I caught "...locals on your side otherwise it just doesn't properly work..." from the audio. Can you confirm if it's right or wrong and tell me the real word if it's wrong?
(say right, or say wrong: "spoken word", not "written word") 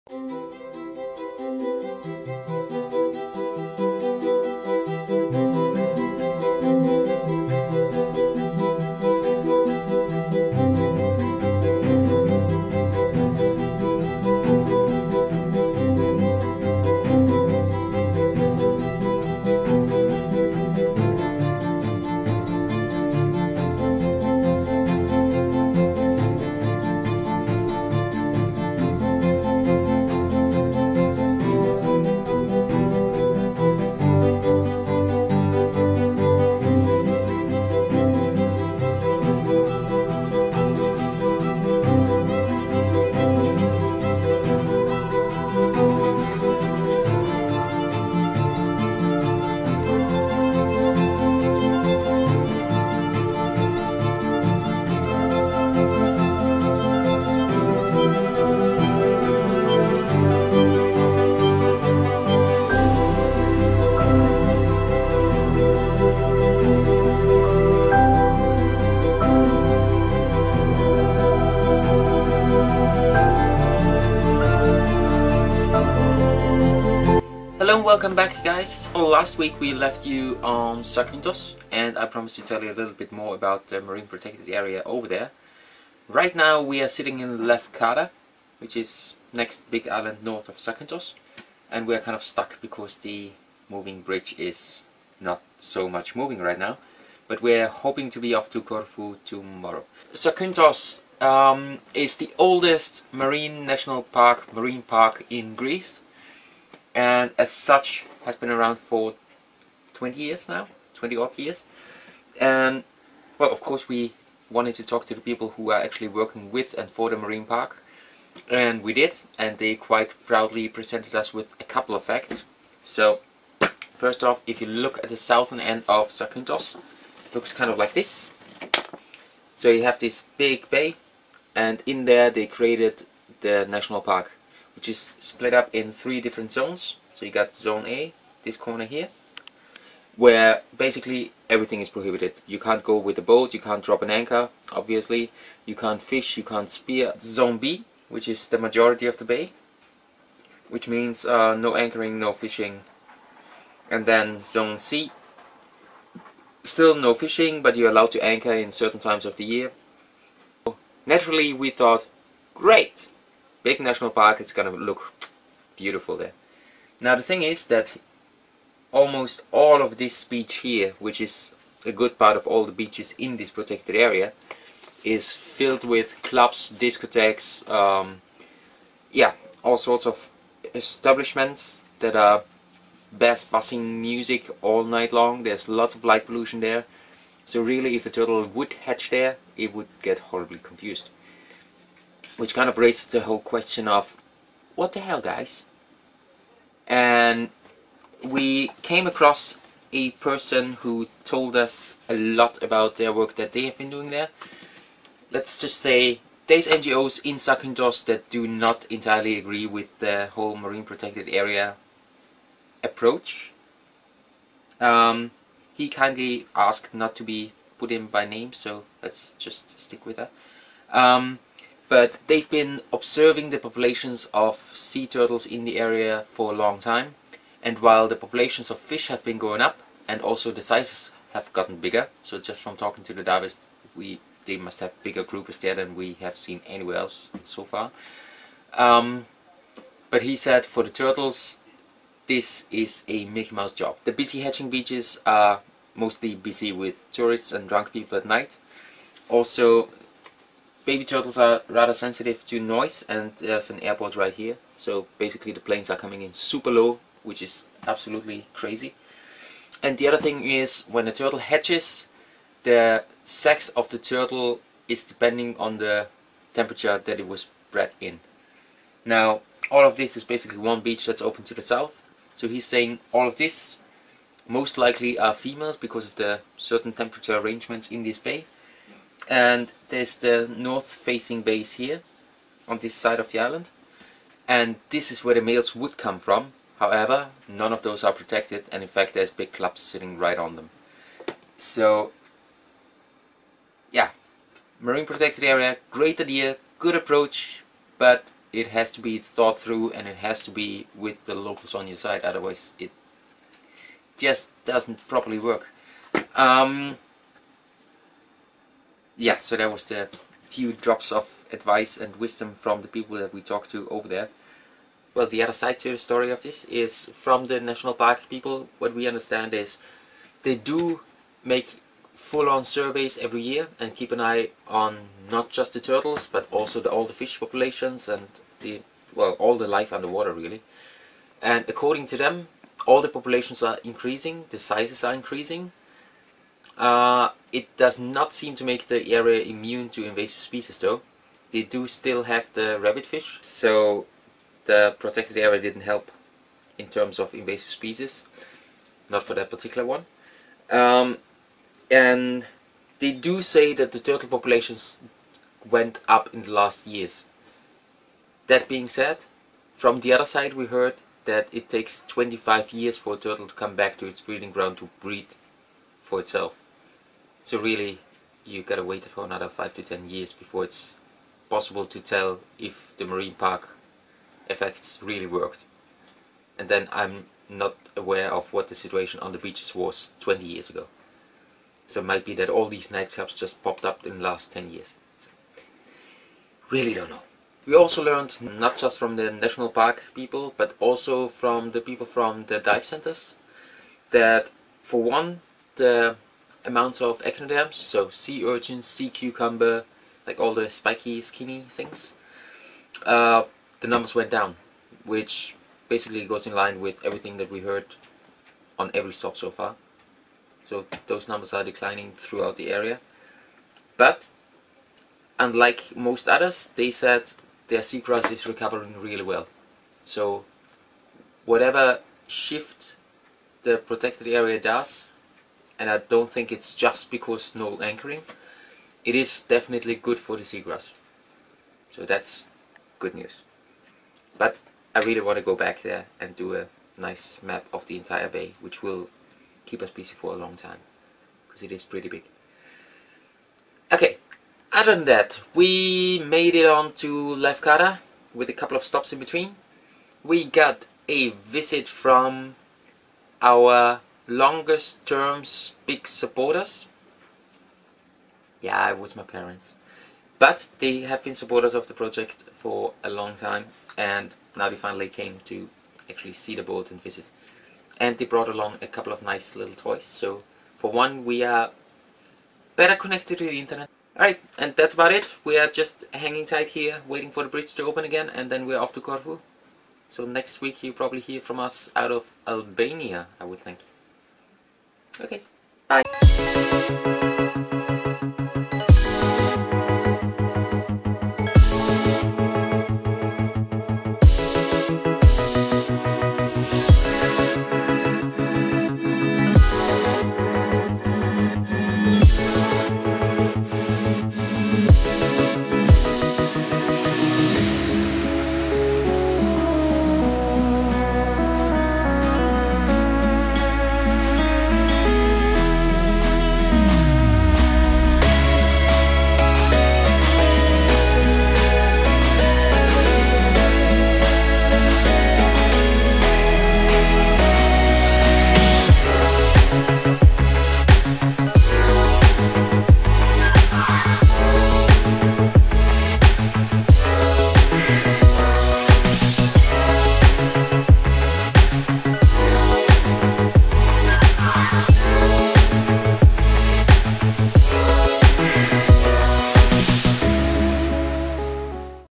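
right.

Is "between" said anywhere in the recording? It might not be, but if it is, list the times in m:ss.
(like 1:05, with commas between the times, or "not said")
7:29.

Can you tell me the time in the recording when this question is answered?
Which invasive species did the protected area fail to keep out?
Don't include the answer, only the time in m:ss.
5:42.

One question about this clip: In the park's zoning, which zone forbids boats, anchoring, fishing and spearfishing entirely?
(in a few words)
Zone A.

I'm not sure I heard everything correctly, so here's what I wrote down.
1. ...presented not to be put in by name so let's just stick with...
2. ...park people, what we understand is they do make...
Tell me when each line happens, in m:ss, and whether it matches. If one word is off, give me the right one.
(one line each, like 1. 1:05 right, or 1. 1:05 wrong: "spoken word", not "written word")
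1. 3:36 wrong: "asked", not "presented"
2. 5:17 right.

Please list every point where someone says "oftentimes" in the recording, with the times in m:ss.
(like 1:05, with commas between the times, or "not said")
not said.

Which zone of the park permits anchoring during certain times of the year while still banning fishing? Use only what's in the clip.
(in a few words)
Zone C.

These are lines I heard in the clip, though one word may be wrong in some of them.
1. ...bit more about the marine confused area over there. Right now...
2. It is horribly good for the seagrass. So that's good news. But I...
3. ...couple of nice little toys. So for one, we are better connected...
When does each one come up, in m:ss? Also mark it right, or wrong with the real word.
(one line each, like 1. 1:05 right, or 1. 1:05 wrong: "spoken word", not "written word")
1. 1:22 wrong: "protected", not "confused"
2. 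7:09 wrong: "definitely", not "horribly"
3. 7:48 right.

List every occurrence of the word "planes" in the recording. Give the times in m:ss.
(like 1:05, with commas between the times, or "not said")
4:15.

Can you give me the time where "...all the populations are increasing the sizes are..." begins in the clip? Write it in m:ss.
5:32.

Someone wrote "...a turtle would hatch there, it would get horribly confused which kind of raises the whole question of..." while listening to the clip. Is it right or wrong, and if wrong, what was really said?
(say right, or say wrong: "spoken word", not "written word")
right.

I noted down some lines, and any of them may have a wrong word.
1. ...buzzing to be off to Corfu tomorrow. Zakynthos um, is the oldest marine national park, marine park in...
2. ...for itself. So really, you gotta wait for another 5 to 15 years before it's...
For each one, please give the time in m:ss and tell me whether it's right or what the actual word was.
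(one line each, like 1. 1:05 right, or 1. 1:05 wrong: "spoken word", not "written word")
1. 1:37 wrong: "hoping", not "buzzing"
2. 6:06 wrong: "10", not "15".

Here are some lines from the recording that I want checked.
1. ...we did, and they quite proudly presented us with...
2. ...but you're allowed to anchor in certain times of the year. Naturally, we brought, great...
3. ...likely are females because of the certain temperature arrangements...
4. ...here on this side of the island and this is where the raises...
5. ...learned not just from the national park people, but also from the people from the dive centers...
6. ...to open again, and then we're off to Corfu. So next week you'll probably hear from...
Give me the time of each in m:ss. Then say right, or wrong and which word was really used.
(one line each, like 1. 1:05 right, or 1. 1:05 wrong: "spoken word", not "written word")
1. 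1:58 right
2. 2:37 wrong: "thought", not "brought"
3. 4:34 right
4. 4:41 wrong: "males", not "raises"
5. 6:28 right
6. 7:57 right.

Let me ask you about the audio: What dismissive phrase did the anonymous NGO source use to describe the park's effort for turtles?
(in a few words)
Mickey Mouse job.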